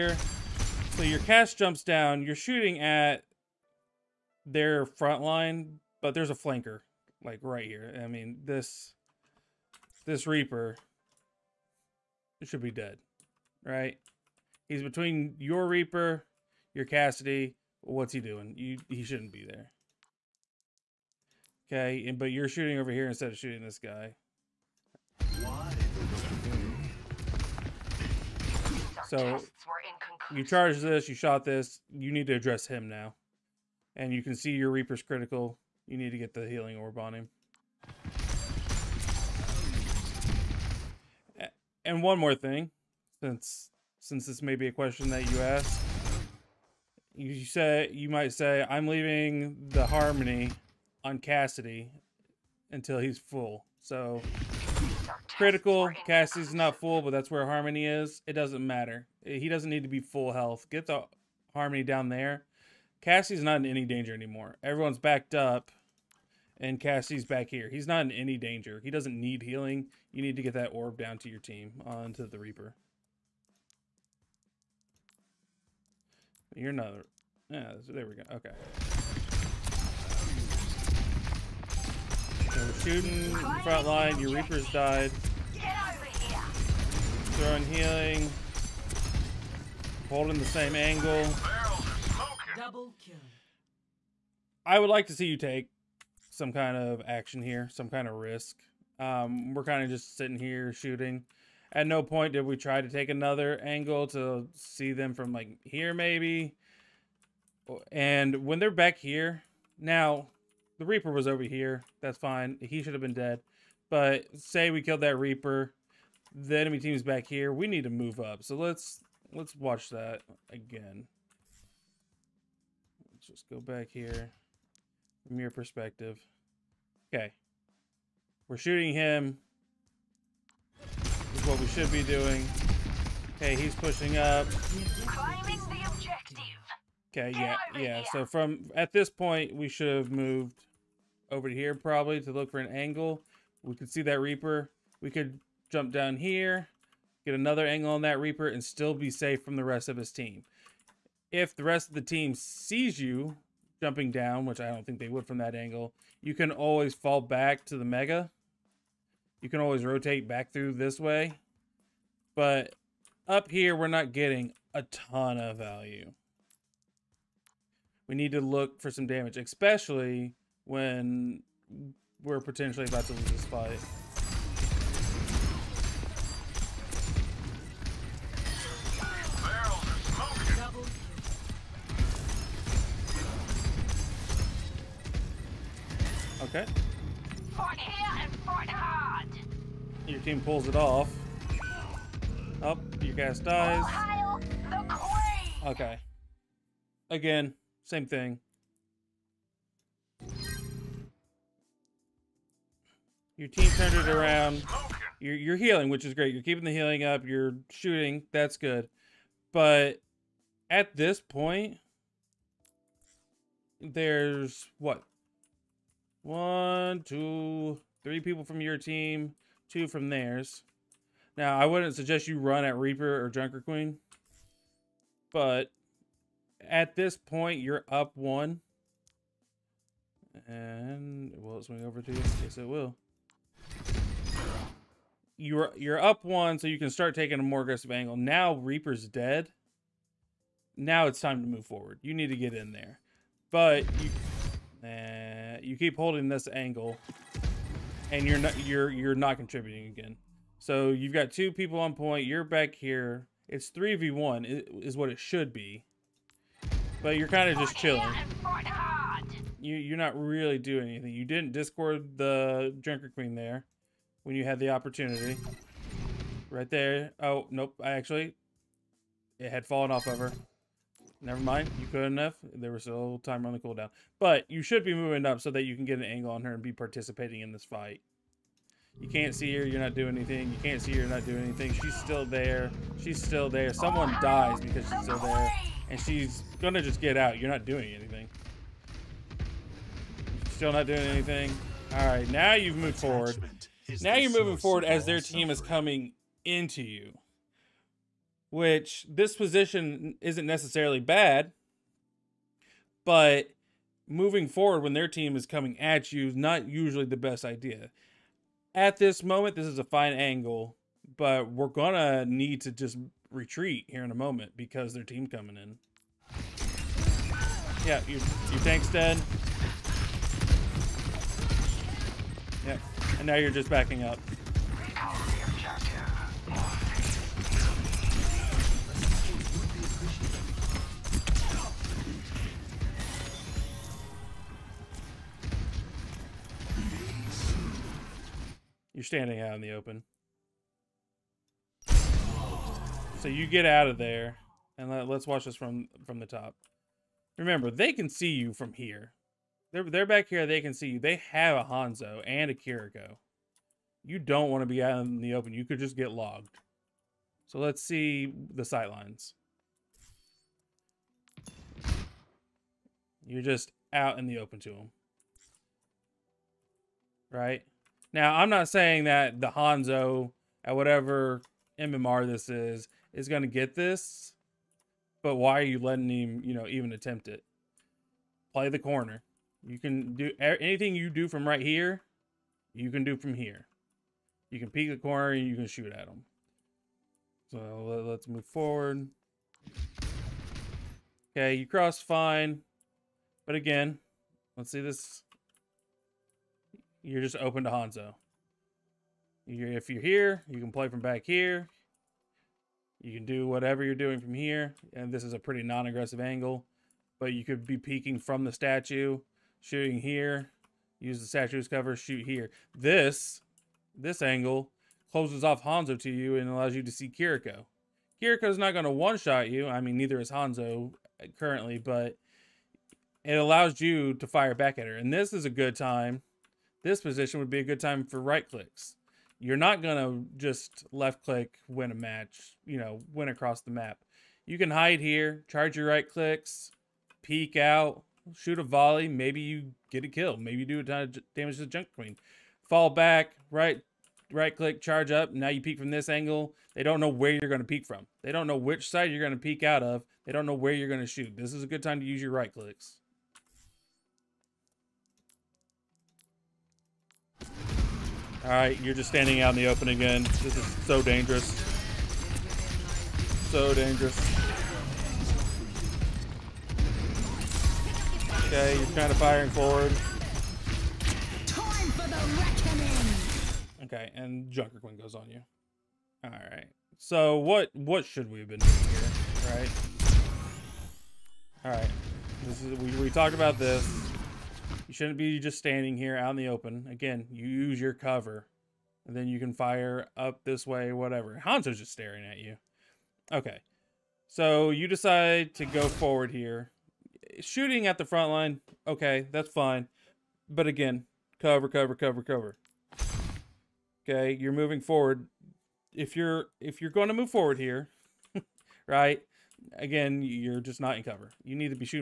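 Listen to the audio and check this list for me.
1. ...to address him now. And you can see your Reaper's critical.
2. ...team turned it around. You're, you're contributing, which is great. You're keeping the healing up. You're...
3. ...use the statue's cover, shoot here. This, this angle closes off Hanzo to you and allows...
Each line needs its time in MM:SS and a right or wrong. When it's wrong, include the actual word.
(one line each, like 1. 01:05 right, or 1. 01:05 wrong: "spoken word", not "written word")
1. 00:32 right
2. 03:23 wrong: "healing", not "contributing"
3. 06:50 right.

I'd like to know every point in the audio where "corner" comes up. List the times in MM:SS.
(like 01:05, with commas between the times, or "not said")
06:18, 06:24.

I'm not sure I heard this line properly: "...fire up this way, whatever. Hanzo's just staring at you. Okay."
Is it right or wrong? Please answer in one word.
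right.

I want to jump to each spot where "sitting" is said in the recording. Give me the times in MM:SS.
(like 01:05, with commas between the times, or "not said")
01:40.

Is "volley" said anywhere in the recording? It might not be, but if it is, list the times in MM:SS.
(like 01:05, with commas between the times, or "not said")
07:18.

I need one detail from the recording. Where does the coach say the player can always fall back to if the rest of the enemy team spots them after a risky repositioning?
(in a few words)
the Mega.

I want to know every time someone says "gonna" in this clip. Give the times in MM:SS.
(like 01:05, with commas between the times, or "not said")
04:46, 05:11.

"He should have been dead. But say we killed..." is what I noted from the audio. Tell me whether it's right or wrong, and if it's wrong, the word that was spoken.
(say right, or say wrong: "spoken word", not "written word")
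right.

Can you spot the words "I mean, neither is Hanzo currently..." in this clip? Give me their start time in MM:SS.
06:59.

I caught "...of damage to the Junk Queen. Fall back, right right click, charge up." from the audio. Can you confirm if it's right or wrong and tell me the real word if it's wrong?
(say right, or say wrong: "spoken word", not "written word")
right.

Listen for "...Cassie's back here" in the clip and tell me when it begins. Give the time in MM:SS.
01:06.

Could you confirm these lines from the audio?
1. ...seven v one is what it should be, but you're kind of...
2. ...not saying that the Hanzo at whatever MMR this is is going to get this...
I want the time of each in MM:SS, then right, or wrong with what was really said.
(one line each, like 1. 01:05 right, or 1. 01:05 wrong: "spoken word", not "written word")
1. 04:13 wrong: "three", not "seven"
2. 06:08 right.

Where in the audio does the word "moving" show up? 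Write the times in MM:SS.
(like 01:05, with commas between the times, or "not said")
04:34, 04:54, 05:04, 08:24.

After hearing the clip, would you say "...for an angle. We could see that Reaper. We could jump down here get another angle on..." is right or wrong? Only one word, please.
right.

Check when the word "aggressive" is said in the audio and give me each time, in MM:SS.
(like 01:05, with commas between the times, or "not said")
03:57, 06:45.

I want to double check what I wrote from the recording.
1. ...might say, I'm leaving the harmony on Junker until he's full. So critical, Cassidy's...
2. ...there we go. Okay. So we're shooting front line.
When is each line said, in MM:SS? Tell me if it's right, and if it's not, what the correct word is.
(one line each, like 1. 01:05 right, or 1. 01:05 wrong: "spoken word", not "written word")
1. 00:48 wrong: "Cassidy", not "Junker"
2. 01:17 right.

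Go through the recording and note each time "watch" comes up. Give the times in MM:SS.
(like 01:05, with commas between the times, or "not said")
01:59, 05:45.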